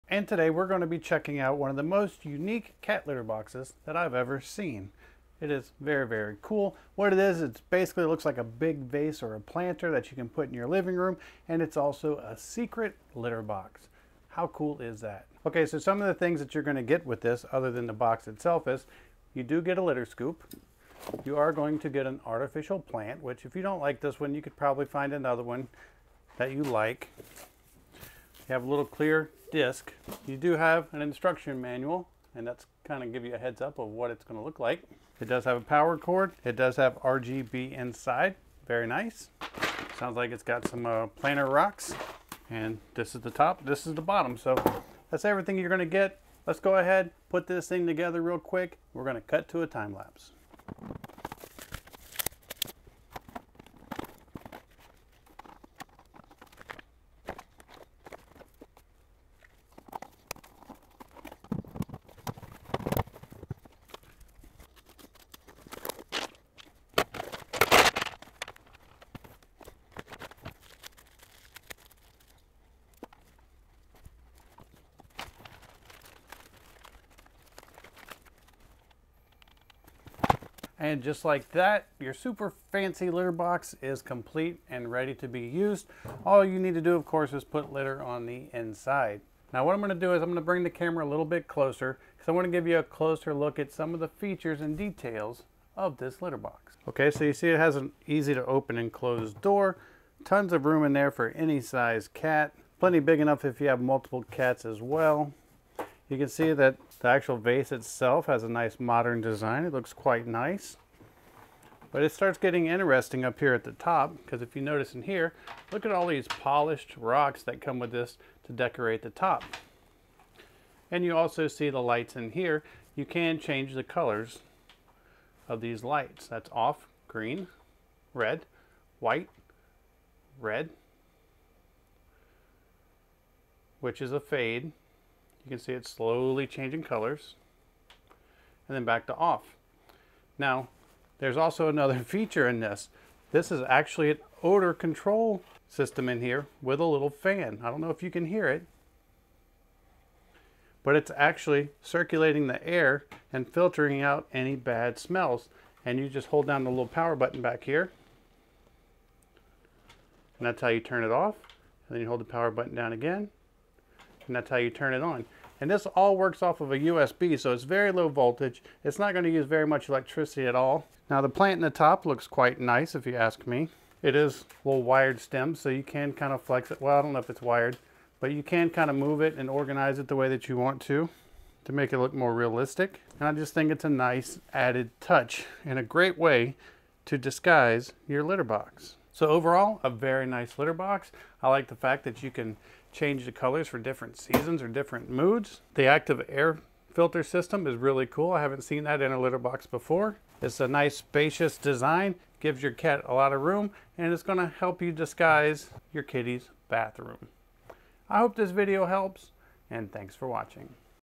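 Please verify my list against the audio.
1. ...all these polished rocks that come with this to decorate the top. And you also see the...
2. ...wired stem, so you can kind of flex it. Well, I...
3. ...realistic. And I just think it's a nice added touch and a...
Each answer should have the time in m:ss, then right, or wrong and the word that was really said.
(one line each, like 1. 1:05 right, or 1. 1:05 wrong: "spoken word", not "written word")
1. 1:55 right
2. 2:54 right
3. 3:02 right.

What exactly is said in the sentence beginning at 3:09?
So overall, a very nice litter box.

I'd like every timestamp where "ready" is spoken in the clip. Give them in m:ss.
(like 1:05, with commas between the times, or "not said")
1:24.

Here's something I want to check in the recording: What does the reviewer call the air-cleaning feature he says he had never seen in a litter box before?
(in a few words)
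active air filter system.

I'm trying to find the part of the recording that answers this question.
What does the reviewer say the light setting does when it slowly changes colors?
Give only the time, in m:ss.
2:14.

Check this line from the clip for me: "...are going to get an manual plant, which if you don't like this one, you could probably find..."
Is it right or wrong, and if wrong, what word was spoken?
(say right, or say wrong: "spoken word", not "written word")
wrong: "artificial", not "manual".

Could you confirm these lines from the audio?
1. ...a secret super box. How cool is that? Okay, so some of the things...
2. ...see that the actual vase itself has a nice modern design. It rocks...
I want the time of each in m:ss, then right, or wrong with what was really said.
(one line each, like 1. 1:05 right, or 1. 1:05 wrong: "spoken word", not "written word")
1. 0:12 wrong: "litter", not "super"
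2. 1:46 wrong: "looks", not "rocks".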